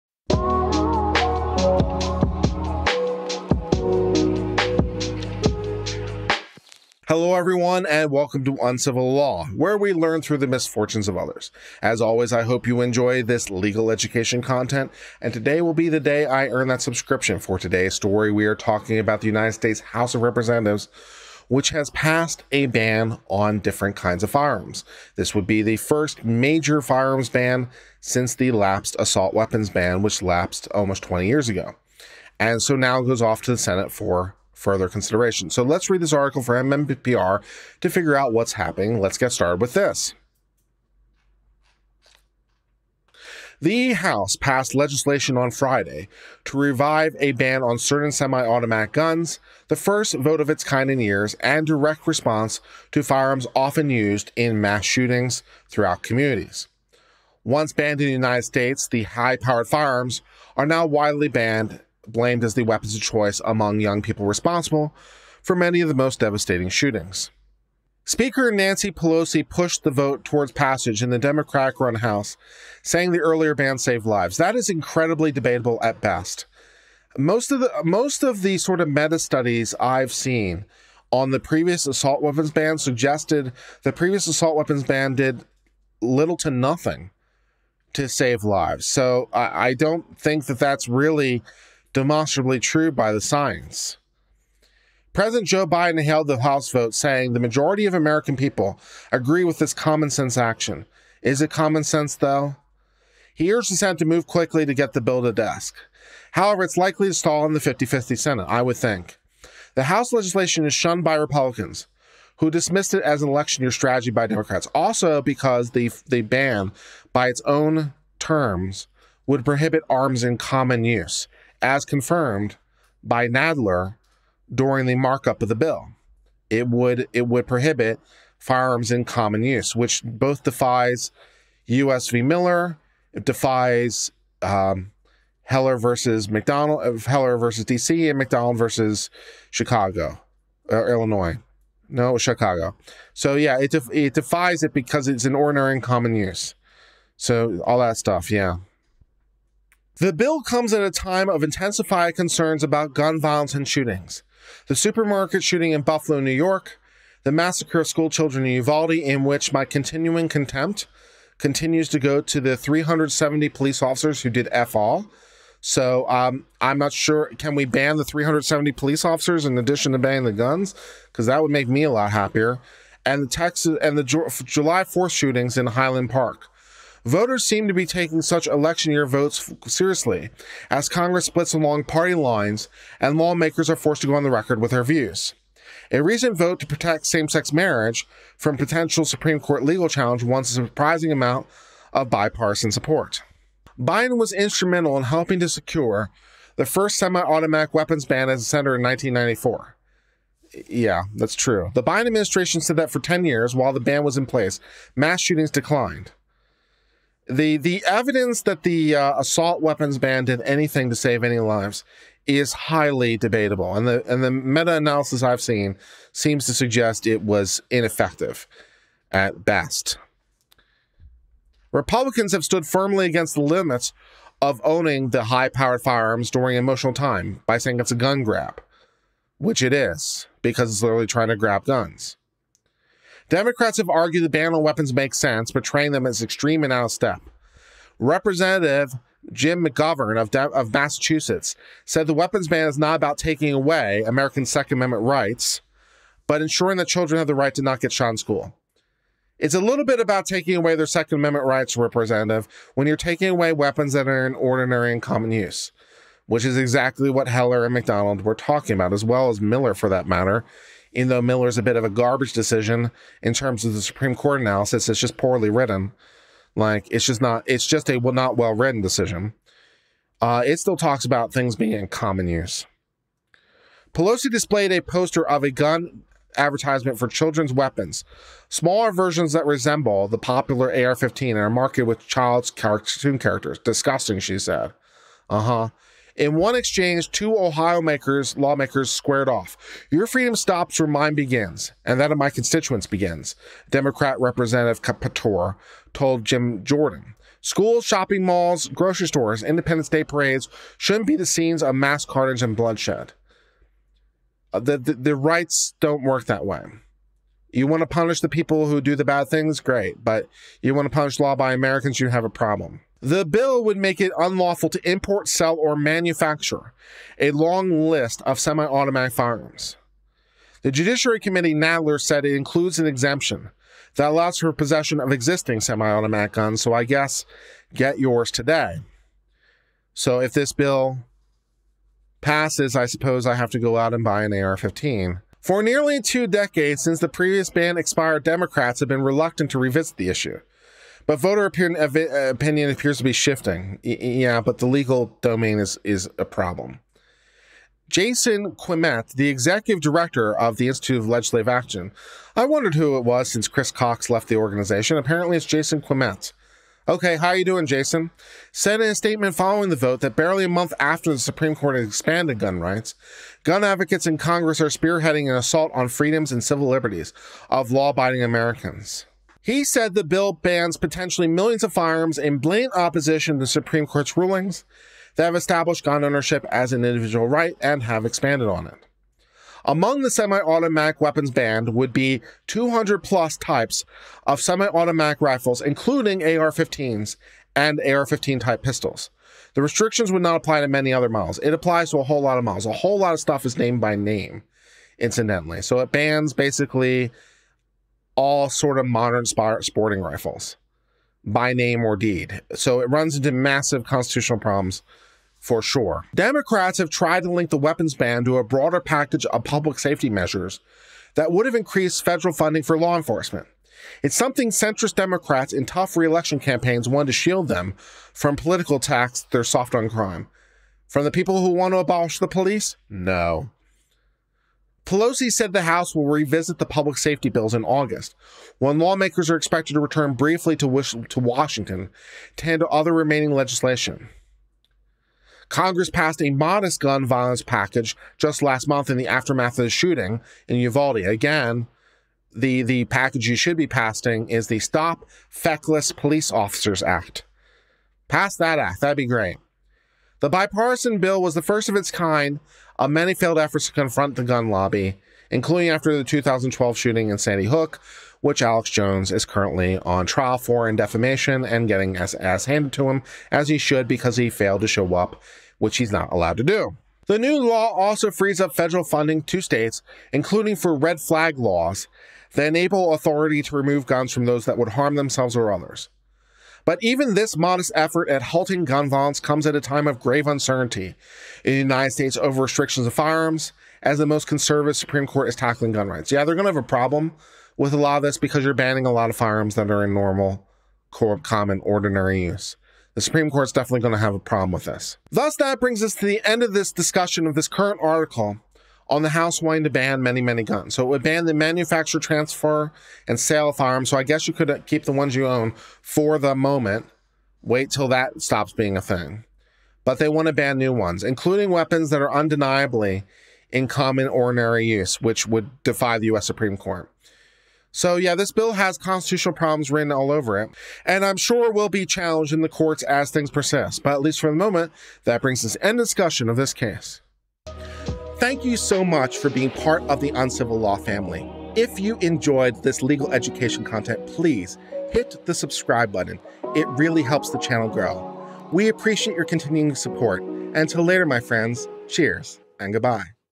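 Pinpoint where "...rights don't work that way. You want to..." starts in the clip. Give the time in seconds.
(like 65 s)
305 s.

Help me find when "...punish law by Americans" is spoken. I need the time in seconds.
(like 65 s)
310 s.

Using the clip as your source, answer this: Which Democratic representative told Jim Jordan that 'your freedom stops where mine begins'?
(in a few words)
Kaptur.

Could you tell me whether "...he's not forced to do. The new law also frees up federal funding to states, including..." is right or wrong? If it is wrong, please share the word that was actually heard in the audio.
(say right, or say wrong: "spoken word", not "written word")
wrong: "allowed", not "forced".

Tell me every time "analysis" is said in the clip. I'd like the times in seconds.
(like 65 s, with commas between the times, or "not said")
214 s, 264 s.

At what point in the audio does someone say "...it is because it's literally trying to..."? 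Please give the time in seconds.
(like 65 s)
229 s.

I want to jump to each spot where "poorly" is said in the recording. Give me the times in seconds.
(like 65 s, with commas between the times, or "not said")
265 s.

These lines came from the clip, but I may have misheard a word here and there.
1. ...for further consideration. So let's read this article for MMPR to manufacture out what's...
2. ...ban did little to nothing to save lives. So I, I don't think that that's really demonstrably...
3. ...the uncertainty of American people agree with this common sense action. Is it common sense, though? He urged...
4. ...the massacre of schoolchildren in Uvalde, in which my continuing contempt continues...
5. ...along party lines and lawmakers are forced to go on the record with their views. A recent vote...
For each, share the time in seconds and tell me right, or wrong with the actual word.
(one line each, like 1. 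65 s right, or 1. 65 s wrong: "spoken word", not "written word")
1. 33 s wrong: "figure", not "manufacture"
2. 84 s right
3. 97 s wrong: "majority", not "uncertainty"
4. 157 s right
5. 181 s right.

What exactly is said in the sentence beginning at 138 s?
and McDonald versus Chicago, or uh, Illinois.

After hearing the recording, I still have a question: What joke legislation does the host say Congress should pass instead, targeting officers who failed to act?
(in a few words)
Stop Feckless Police Officers Act.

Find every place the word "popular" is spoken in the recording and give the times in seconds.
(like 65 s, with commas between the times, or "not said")
280 s.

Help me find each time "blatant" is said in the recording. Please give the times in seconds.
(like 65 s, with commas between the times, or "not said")
372 s.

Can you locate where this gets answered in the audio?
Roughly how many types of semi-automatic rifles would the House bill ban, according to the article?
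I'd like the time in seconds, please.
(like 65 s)
382 s.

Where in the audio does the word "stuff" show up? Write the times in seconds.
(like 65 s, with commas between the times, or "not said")
147 s, 393 s.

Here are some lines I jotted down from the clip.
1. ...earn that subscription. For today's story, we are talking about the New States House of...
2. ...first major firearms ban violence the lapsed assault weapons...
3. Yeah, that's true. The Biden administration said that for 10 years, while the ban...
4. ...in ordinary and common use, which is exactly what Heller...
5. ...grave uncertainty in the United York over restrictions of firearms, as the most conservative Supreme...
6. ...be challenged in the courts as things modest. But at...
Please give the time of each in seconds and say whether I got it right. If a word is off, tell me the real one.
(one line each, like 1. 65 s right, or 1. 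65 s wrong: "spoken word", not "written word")
1. 16 s wrong: "United", not "New"
2. 25 s wrong: "since", not "violence"
3. 200 s right
4. 254 s right
5. 479 s wrong: "States", not "York"
6. 521 s wrong: "persist", not "modest".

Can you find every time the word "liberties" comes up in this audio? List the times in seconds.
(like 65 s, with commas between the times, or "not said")
366 s.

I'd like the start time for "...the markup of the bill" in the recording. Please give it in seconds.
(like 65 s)
124 s.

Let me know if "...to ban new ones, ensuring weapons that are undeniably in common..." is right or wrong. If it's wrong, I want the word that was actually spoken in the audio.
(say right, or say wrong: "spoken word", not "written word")
wrong: "including", not "ensuring".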